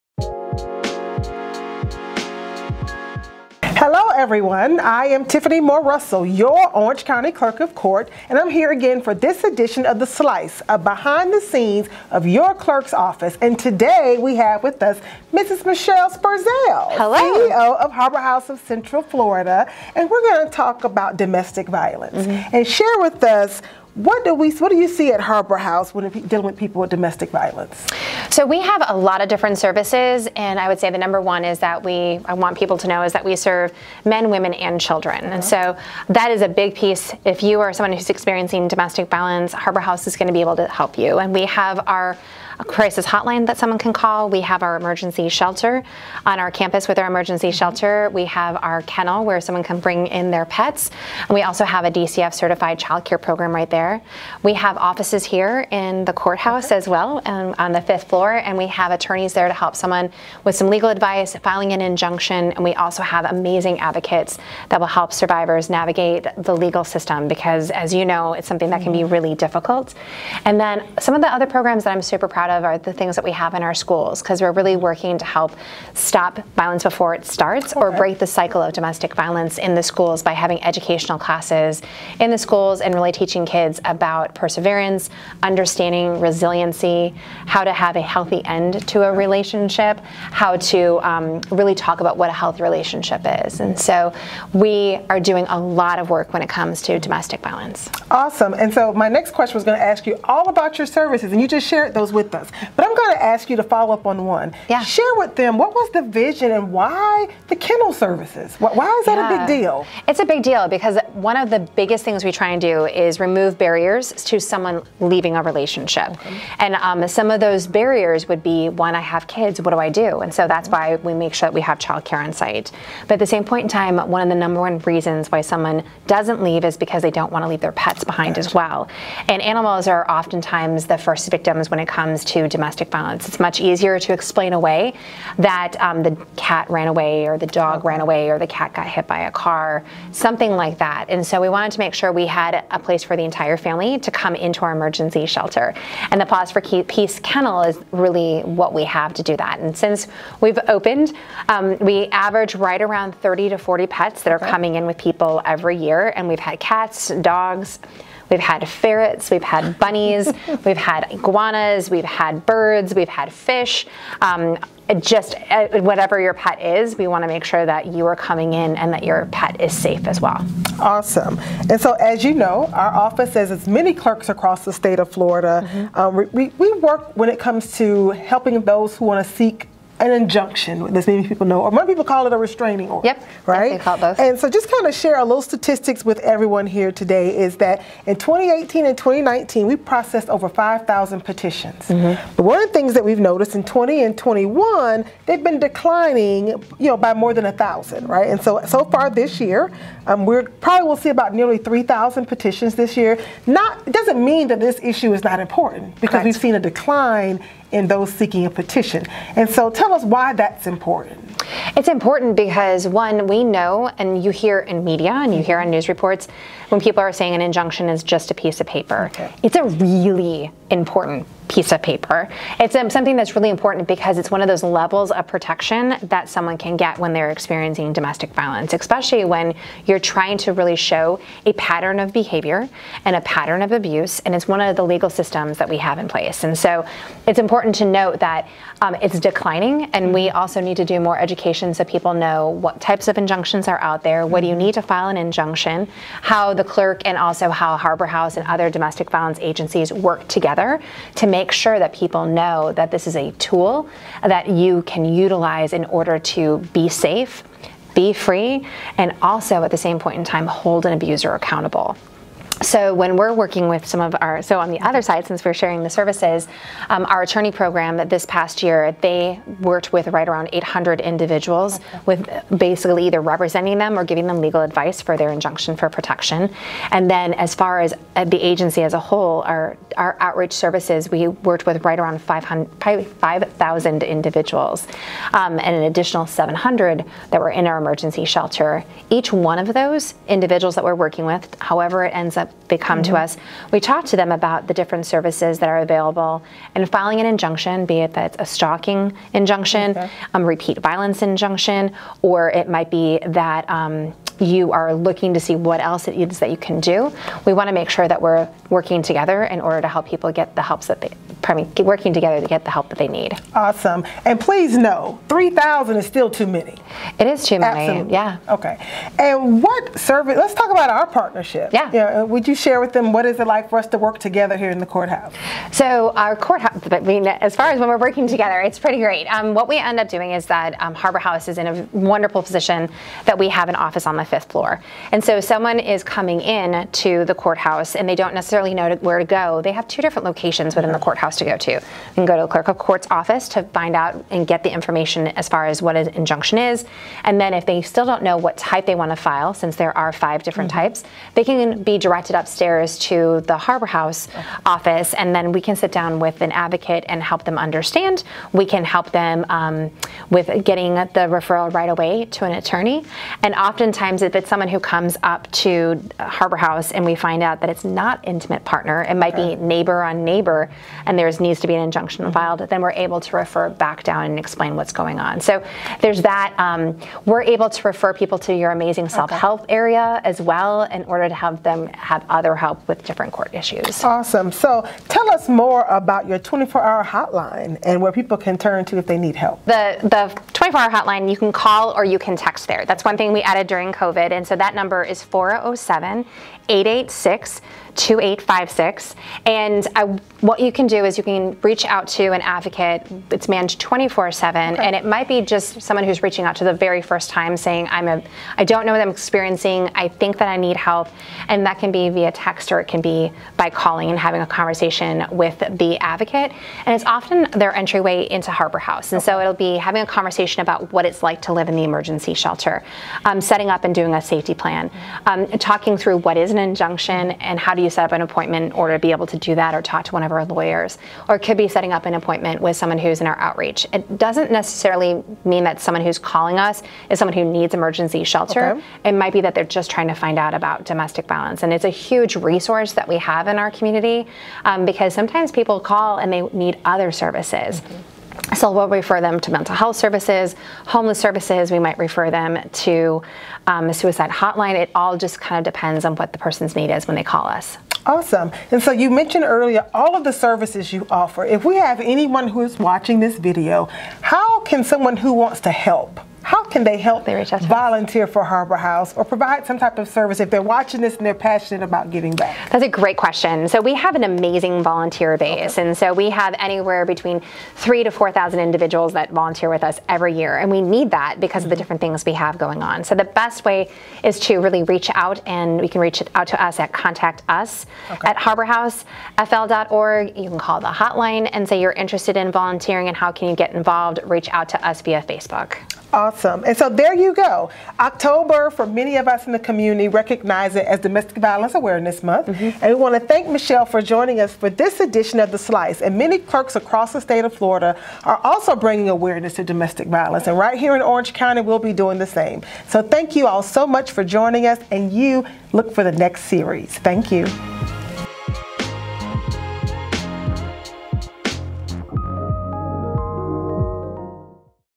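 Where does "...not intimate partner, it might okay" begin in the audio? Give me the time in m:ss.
6:07.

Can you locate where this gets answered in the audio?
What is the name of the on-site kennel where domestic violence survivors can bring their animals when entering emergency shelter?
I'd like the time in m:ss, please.
2:26.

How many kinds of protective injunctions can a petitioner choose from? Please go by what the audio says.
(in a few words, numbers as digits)
Five.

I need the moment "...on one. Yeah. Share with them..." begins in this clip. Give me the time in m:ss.
1:44.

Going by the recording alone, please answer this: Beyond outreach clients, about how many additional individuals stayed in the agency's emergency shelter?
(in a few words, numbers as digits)
700.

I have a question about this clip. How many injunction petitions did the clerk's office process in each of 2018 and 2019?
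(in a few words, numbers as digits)
Over 5,000.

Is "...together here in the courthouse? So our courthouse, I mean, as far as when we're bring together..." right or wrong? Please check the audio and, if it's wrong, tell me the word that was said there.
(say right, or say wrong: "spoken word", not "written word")
wrong: "working", not "bring".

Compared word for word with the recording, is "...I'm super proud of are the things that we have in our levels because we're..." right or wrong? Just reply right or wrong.
wrong.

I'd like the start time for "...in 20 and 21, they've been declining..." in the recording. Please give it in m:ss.
3:13.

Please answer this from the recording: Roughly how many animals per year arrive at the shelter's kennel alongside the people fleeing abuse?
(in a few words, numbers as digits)
30 to 40.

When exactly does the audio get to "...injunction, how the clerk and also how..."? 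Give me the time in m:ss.
4:05.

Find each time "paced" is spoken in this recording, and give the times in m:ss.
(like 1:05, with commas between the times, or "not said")
not said.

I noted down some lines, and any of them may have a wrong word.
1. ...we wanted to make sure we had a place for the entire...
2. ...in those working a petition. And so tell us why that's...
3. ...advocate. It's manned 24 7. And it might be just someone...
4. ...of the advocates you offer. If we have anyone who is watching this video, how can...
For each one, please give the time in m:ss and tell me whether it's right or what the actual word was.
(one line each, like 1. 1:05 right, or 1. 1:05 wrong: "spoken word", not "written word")
1. 2:21 right
2. 3:27 wrong: "seeking", not "working"
3. 6:42 right
4. 7:40 wrong: "services", not "advocates".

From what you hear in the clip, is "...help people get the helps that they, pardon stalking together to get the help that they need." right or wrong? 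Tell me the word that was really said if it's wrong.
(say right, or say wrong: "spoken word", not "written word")
wrong: "working", not "stalking".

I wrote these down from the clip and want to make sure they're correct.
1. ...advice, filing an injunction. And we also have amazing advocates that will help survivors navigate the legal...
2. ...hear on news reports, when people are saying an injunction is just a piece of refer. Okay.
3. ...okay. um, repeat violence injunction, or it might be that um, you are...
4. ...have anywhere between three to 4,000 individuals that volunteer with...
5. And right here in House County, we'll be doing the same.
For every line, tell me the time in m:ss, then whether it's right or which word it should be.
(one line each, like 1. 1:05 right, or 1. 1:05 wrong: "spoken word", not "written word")
1. 1:00 right
2. 3:35 wrong: "paper", not "refer"
3. 4:59 right
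4. 7:56 right
5. 8:30 wrong: "Orange", not "House".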